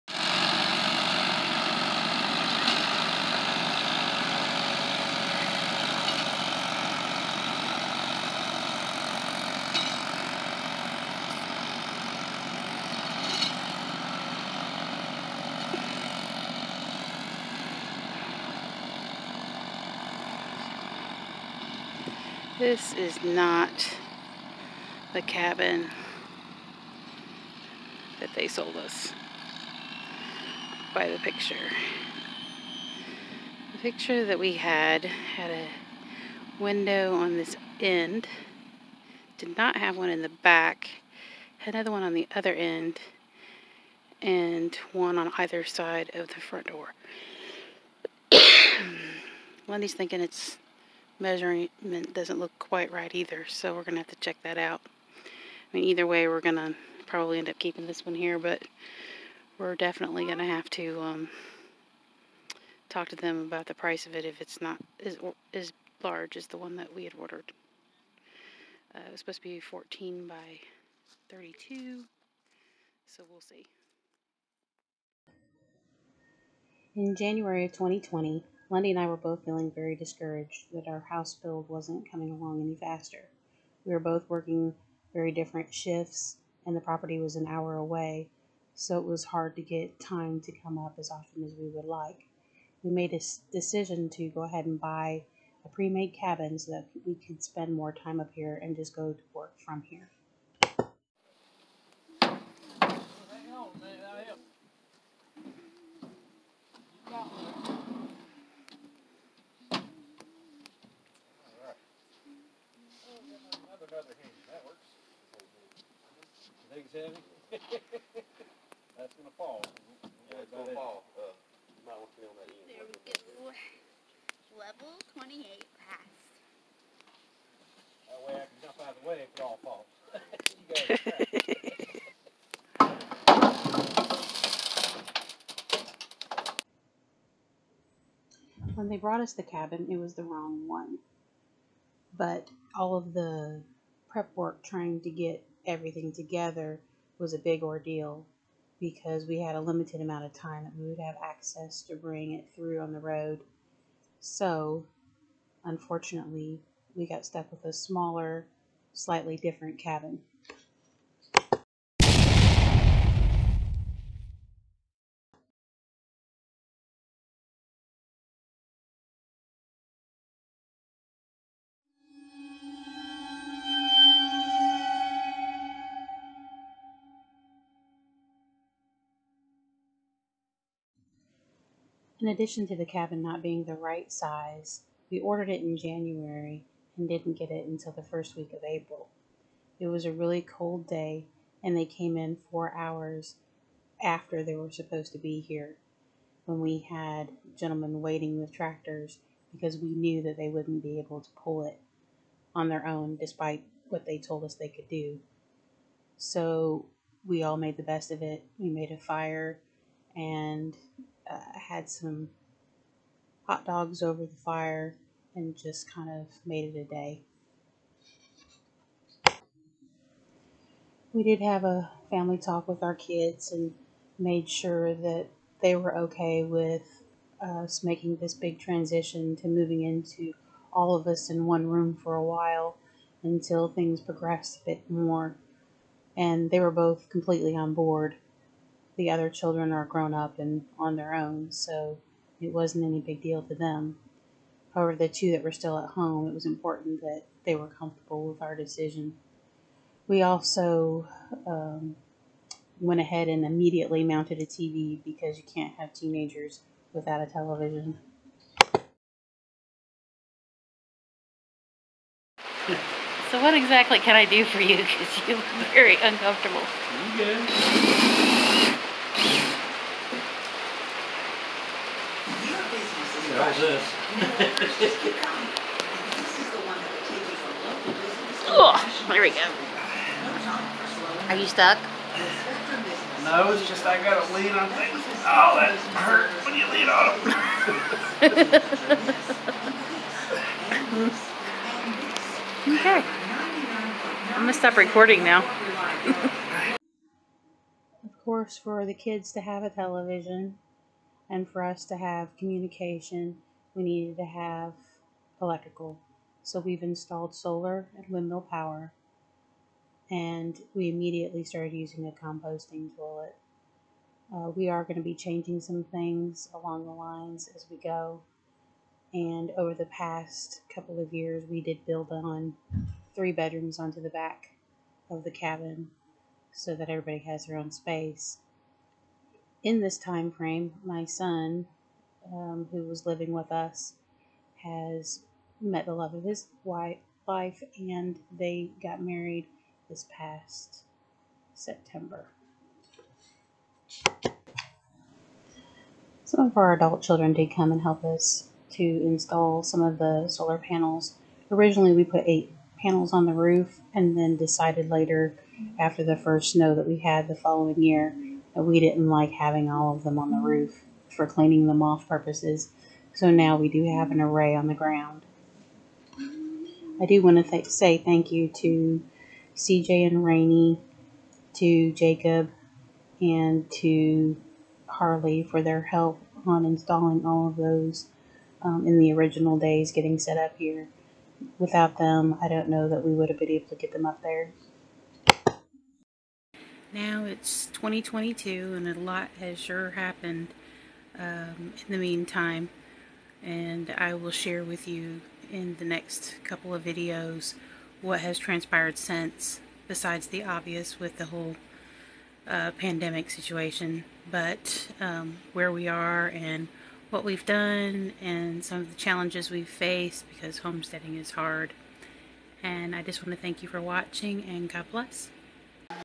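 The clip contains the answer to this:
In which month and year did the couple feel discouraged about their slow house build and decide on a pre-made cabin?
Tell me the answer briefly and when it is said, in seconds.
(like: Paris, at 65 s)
January 2020, at 77 s.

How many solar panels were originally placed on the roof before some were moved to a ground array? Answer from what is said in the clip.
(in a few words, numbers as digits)
8.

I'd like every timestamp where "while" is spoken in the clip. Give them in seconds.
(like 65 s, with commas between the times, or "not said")
232 s.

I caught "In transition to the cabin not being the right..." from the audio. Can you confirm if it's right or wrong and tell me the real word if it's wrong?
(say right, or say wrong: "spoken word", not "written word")
wrong: "addition", not "transition".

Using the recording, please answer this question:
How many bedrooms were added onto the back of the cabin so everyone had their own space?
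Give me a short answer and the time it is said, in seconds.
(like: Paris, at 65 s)
3, at 323 s.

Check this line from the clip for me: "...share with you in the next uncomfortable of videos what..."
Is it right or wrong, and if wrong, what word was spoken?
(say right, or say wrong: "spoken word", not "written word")
wrong: "couple", not "uncomfortable".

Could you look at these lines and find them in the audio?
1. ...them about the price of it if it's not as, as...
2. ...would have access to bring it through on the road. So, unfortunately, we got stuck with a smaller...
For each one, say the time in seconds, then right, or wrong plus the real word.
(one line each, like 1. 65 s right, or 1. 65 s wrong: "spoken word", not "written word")
1. 63 s right
2. 150 s right.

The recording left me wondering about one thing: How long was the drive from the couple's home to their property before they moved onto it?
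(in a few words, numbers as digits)
an hour.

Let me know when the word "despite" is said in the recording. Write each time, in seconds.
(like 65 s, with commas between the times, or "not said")
203 s.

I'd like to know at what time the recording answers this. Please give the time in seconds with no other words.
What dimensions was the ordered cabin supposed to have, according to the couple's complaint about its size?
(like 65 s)
69 s.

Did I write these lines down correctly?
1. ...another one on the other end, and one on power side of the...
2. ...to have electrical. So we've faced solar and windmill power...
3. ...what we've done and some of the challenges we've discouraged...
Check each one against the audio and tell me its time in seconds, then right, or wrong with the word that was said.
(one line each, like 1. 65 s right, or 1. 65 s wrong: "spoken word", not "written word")
1. 41 s wrong: "either", not "power"
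2. 304 s wrong: "installed", not "faced"
3. 407 s wrong: "faced", not "discouraged".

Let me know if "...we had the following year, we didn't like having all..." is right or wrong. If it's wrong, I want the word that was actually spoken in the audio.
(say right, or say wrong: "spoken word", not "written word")
right.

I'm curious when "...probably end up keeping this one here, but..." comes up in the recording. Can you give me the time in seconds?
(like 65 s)
57 s.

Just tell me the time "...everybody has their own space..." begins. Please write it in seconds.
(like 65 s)
326 s.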